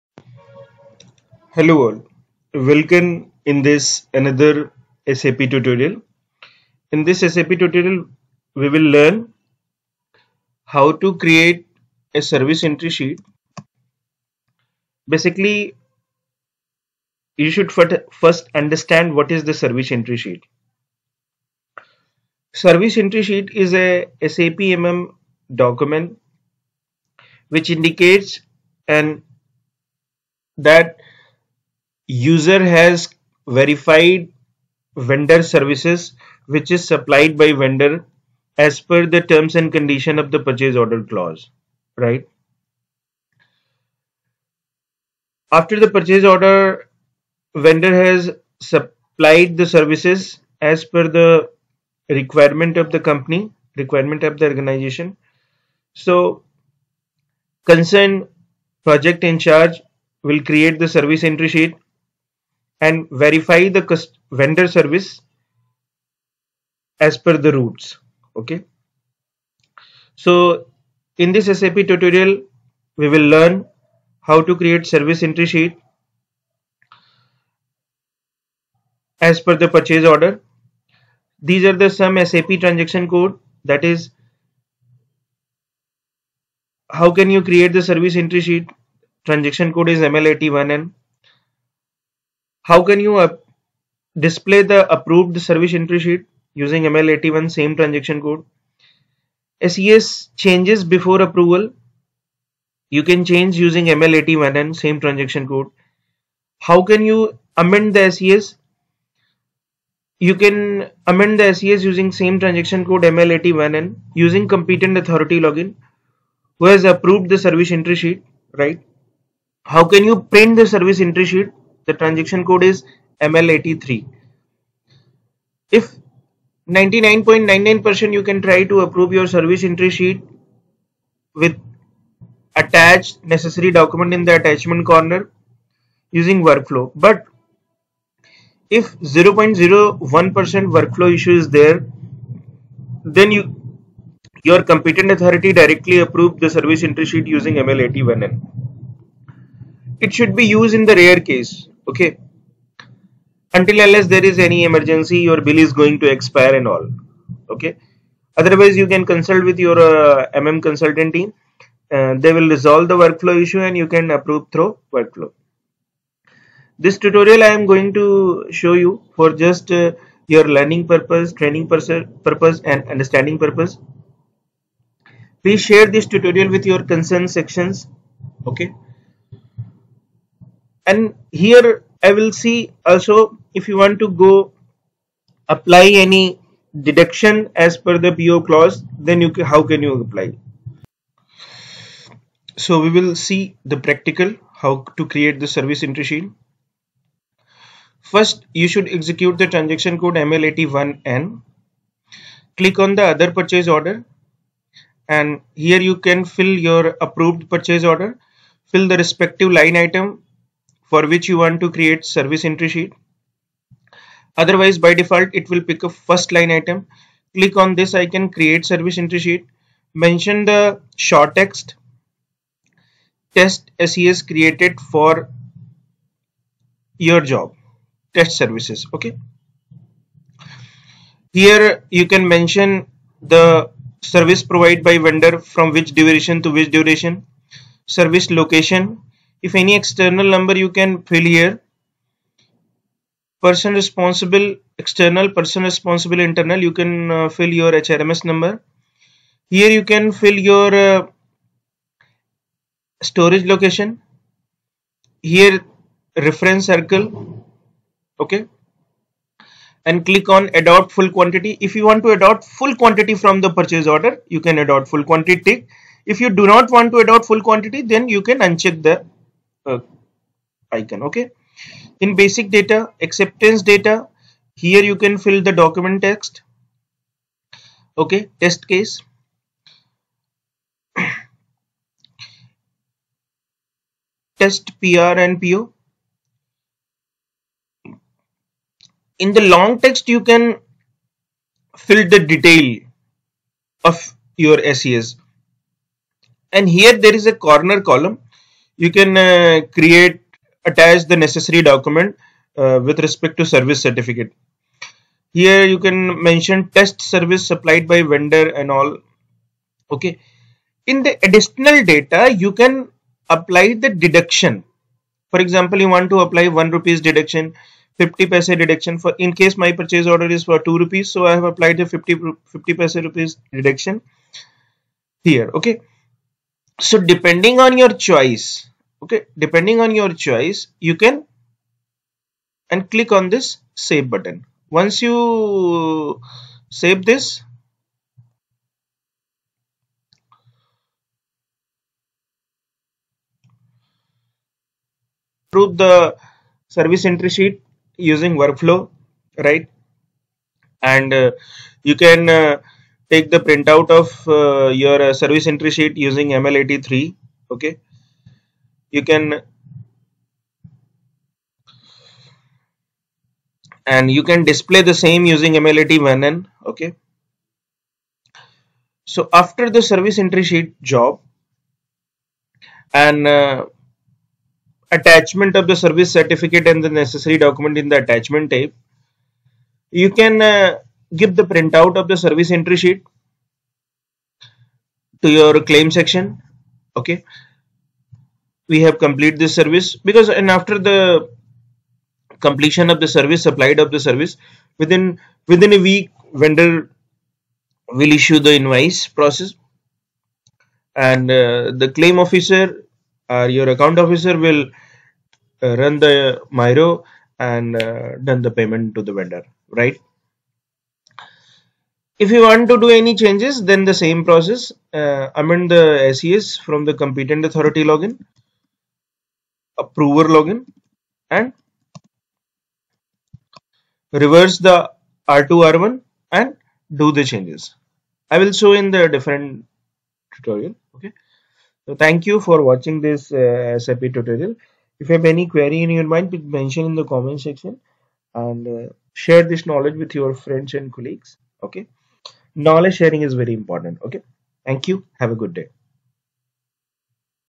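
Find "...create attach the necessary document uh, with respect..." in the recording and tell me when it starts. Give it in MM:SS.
04:59.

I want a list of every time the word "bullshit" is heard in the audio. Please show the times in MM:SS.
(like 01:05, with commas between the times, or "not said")
not said.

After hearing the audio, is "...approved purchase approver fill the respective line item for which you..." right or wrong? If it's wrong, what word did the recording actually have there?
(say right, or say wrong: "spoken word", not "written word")
wrong: "order", not "approver".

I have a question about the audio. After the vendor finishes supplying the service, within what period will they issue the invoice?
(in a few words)
within a week.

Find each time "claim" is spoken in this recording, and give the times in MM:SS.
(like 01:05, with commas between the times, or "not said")
06:25, 06:41.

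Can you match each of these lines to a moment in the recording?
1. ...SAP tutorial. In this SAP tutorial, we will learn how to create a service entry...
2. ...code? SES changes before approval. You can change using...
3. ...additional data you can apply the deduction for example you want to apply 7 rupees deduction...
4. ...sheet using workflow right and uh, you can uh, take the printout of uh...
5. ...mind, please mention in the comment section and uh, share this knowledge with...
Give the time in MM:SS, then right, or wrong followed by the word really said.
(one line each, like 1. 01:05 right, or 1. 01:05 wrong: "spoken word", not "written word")
1. 00:05 right
2. 01:38 right
3. 05:11 wrong: "1", not "7"
4. 05:47 right
5. 07:16 right.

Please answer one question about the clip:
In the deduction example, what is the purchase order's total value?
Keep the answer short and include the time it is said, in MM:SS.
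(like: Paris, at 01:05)
2 rupees, at 05:20.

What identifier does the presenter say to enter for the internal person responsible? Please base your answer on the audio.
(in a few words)
HRMS number.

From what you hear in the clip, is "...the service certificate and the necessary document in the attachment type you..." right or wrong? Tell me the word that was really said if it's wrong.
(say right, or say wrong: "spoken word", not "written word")
right.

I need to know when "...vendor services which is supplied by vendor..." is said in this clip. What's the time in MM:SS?
00:34.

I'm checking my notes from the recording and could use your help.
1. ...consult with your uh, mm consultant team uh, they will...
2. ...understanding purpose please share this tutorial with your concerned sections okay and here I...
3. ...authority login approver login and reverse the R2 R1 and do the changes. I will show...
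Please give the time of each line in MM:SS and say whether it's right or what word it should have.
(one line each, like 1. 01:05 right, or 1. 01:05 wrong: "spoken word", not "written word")
1. 02:39 right
2. 02:52 right
3. 06:57 right.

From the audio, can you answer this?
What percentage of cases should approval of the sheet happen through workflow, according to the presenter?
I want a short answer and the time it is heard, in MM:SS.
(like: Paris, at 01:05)
99.99%, at 02:06.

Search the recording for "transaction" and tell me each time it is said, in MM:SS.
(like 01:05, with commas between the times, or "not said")
01:22, 01:29, 01:37, 01:44, 01:52, 02:01, 03:19.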